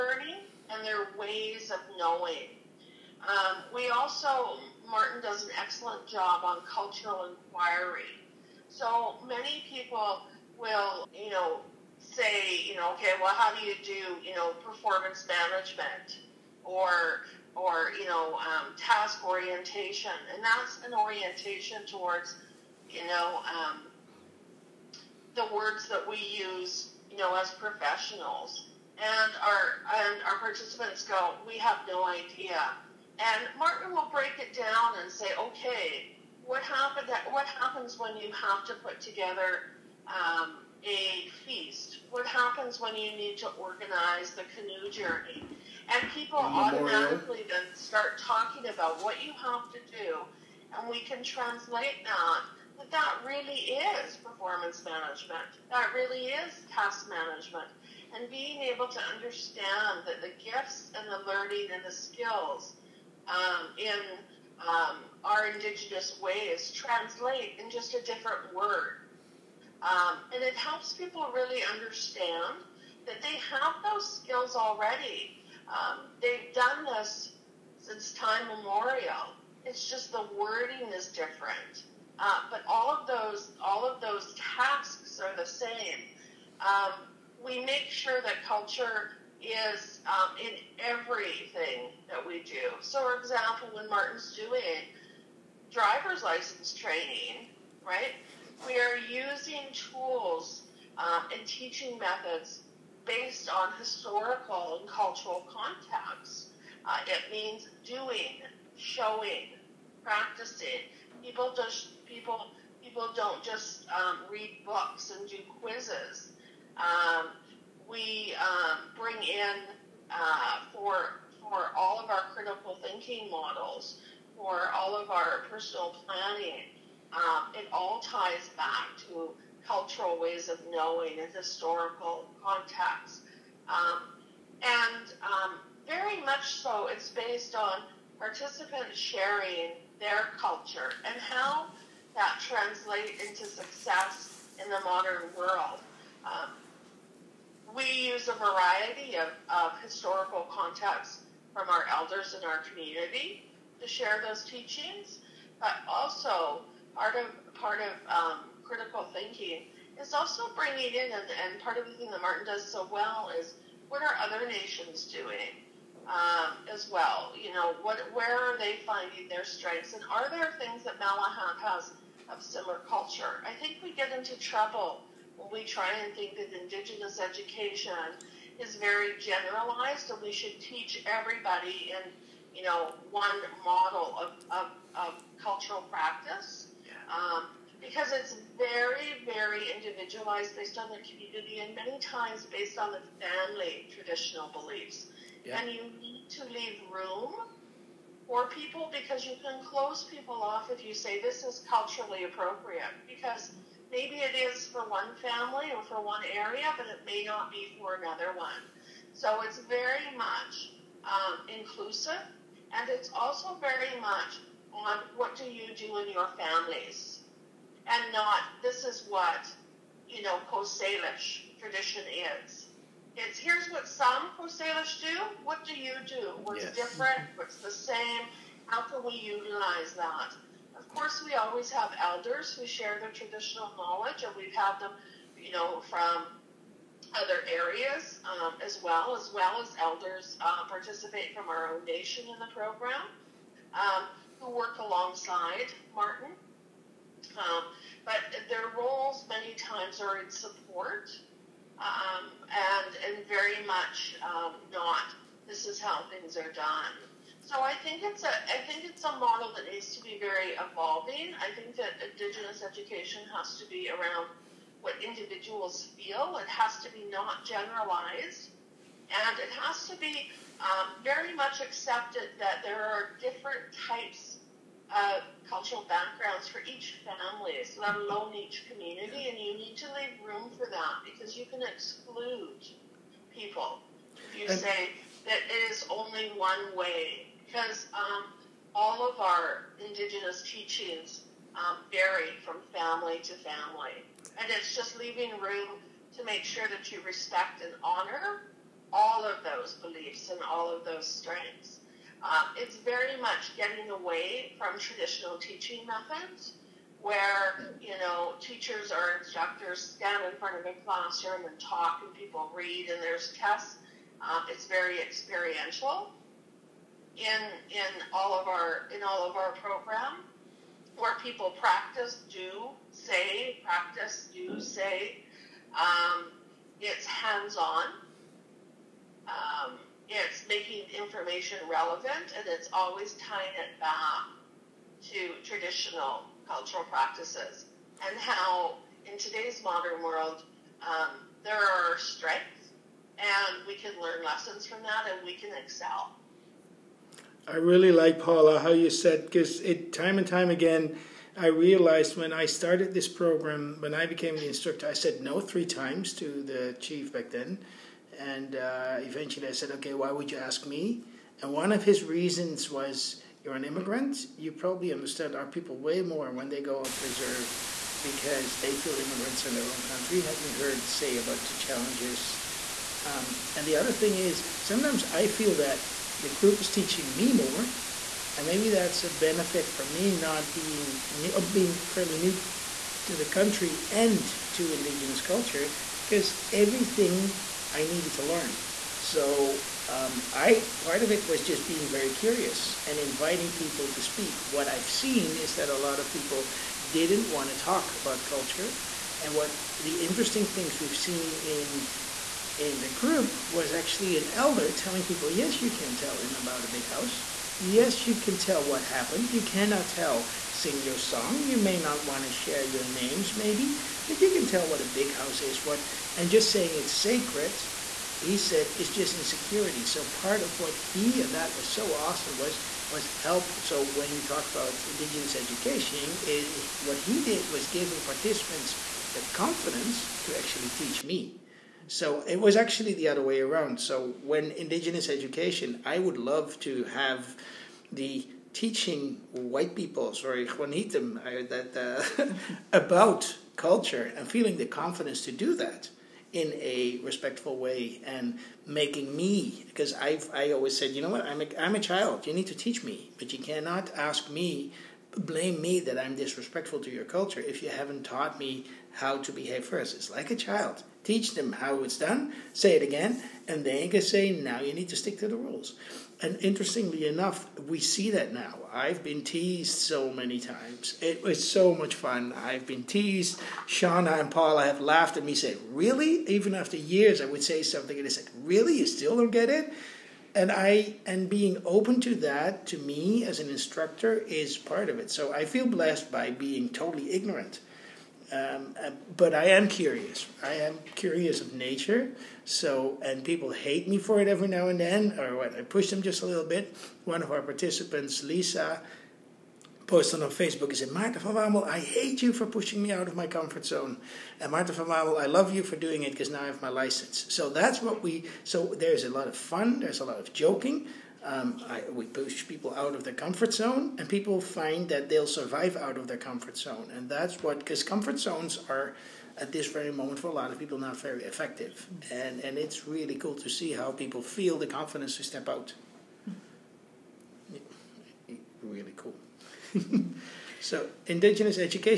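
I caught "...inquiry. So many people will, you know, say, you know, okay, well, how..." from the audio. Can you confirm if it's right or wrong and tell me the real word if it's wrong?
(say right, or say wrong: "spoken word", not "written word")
right.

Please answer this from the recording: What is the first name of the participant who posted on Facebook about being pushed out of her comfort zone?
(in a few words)
Lisa.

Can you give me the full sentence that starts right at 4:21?
I think that Indigenous education has to be around what individuals feel.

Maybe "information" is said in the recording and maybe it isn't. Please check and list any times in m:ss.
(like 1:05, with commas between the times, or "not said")
5:30.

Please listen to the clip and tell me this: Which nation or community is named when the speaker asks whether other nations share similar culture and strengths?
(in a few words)
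Malahat.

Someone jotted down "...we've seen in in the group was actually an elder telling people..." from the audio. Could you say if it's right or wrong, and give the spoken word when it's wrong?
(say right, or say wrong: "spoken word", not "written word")
right.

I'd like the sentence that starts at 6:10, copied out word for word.
Had me heard say about the challenges.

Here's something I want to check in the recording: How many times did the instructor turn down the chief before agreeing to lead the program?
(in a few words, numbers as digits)
3.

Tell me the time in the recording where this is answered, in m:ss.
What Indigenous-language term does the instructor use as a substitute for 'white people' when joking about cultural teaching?
7:20.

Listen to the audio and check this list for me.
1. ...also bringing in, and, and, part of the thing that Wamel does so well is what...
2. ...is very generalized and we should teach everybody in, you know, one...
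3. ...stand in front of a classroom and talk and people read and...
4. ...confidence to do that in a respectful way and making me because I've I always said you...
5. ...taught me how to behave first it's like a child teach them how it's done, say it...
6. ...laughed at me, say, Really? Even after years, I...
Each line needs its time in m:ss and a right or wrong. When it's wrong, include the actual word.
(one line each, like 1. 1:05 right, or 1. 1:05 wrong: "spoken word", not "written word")
1. 2:40 wrong: "Martin", not "Wamel"
2. 2:58 right
3. 5:09 right
4. 7:24 right
5. 7:38 right
6. 7:54 right.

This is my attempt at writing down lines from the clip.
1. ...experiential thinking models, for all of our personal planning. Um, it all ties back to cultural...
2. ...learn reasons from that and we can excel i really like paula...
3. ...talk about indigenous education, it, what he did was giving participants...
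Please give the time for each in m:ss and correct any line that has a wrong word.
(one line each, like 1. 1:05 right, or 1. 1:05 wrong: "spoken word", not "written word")
1. 2:02 wrong: "critical", not "experiential"
2. 5:43 wrong: "lessons", not "reasons"
3. 7:04 right.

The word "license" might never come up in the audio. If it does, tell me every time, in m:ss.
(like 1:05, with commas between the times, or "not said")
1:36, 8:26.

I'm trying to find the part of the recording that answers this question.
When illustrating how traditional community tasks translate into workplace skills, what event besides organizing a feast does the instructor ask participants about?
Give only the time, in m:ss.
0:44.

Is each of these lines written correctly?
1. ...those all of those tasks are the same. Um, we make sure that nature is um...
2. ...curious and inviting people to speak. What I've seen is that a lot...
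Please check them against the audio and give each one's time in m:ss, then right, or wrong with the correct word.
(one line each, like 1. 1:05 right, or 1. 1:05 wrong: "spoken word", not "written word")
1. 1:23 wrong: "culture", not "nature"
2. 6:32 right.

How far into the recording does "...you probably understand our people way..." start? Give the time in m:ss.
6:04.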